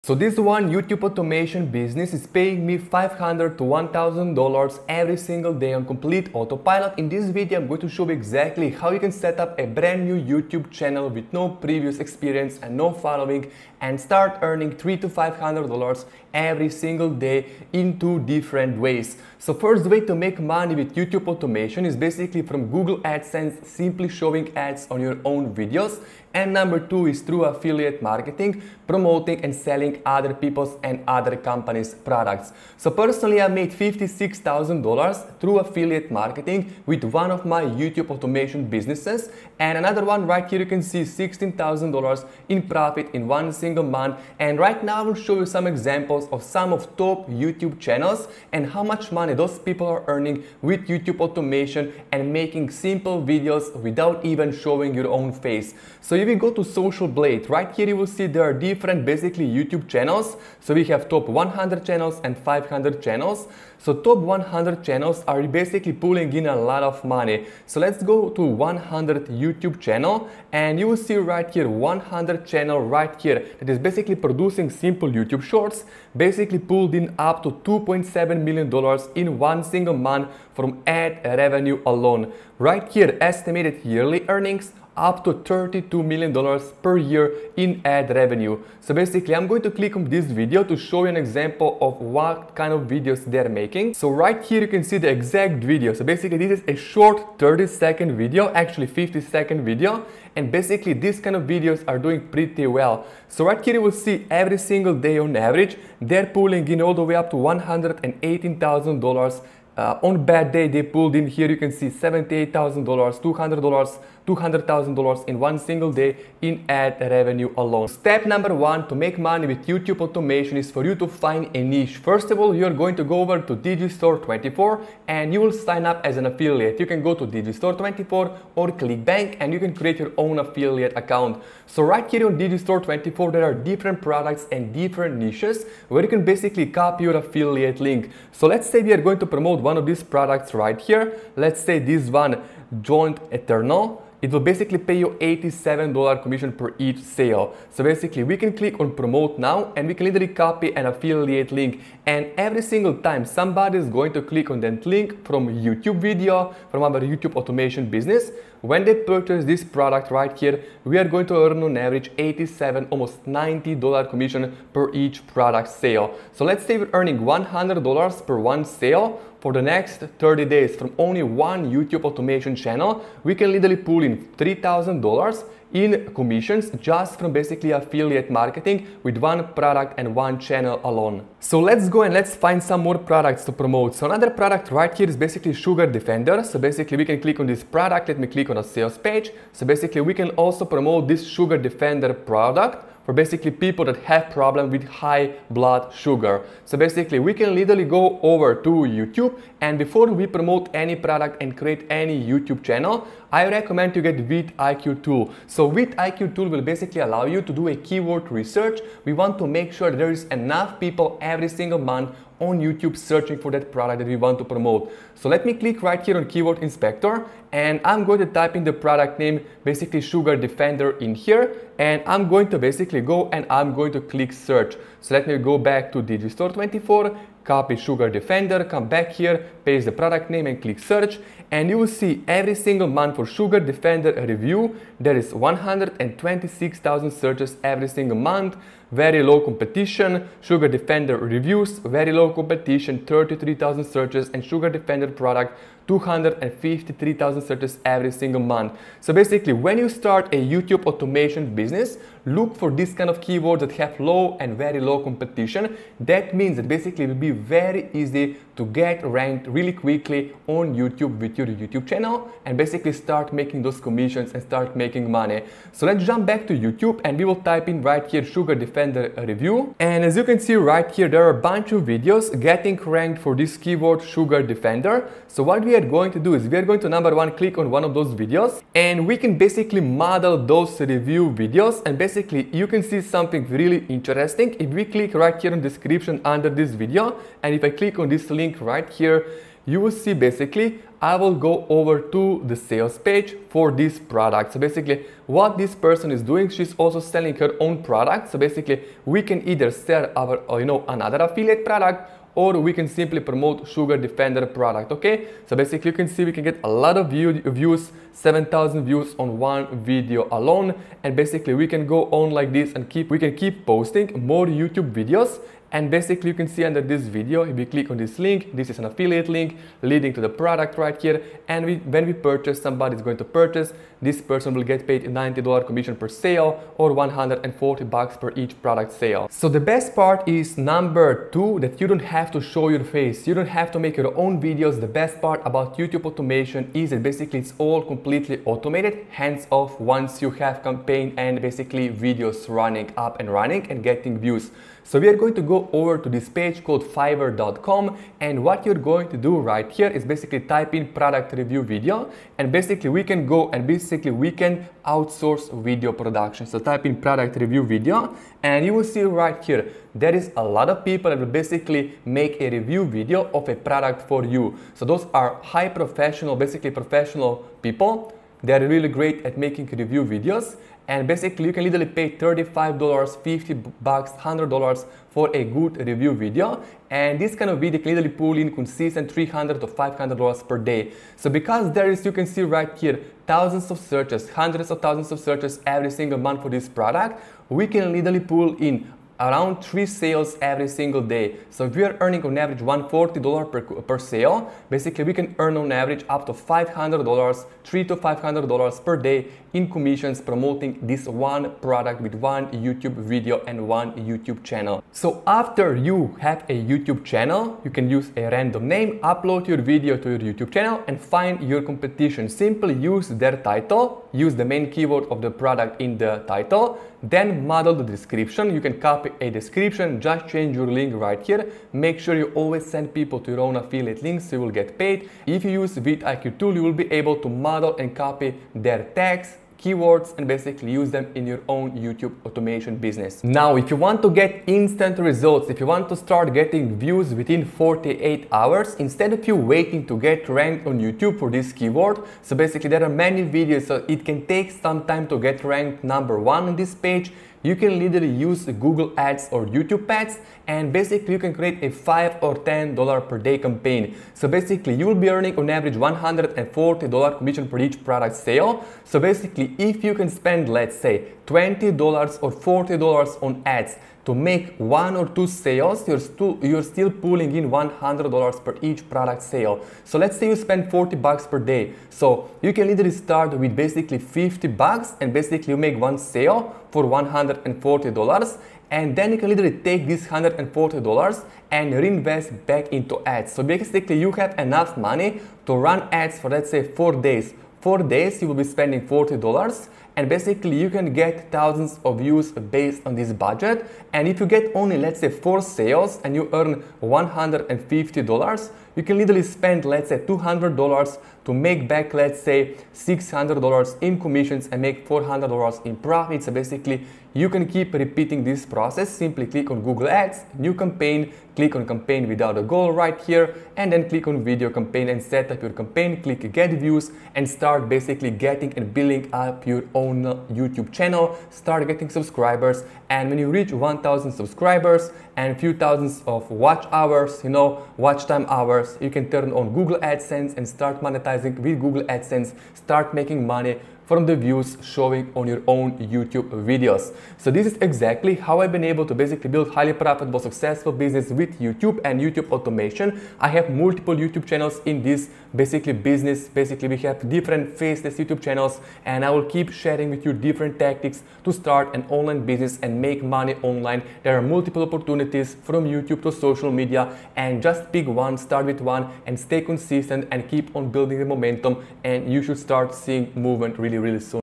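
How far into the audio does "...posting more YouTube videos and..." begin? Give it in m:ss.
5:13.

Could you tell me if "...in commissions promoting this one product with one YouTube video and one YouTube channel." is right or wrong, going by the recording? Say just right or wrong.
right.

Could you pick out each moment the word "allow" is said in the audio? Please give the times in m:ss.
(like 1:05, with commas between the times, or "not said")
3:27.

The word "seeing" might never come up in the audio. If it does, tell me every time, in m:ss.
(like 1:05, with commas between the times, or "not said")
9:22.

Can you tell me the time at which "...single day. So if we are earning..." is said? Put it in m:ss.
6:30.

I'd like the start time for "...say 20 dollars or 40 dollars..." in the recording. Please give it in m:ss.
7:40.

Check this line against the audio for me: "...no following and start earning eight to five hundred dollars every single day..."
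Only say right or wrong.
wrong.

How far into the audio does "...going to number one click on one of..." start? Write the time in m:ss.
4:36.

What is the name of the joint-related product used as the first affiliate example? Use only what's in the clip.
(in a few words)
Joint Eternal.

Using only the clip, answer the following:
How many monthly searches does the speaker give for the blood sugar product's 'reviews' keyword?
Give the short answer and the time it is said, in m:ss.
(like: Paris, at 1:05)
33,000, at 4:03.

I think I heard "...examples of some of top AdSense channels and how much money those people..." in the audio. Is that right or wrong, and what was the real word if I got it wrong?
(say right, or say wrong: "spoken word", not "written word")
wrong: "YouTube", not "AdSense".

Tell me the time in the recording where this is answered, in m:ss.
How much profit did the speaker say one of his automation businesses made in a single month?
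0:41.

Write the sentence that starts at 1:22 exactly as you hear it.
Right here, estimated yearly earnings up to $32 million per year in ad revenue.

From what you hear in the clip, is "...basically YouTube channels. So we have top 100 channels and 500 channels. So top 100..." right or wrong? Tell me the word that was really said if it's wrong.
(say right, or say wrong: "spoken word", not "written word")
right.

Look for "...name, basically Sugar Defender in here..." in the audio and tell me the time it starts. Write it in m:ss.
3:39.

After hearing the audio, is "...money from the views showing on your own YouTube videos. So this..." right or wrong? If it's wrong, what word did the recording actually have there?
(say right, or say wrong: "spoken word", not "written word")
right.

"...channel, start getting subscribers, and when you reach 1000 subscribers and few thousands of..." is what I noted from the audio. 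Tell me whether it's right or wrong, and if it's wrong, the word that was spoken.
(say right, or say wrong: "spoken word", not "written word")
right.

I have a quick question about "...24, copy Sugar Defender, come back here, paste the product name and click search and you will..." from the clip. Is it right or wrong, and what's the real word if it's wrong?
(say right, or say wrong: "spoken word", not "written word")
right.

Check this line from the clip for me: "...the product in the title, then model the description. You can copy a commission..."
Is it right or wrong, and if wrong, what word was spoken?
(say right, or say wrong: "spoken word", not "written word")
wrong: "description", not "commission".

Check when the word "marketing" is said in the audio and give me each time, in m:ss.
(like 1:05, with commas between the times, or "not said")
0:28, 0:36, 2:58.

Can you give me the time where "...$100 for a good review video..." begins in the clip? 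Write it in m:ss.
6:13.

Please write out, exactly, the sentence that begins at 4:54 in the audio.
So basically what this person is doing, she's also selling her own product.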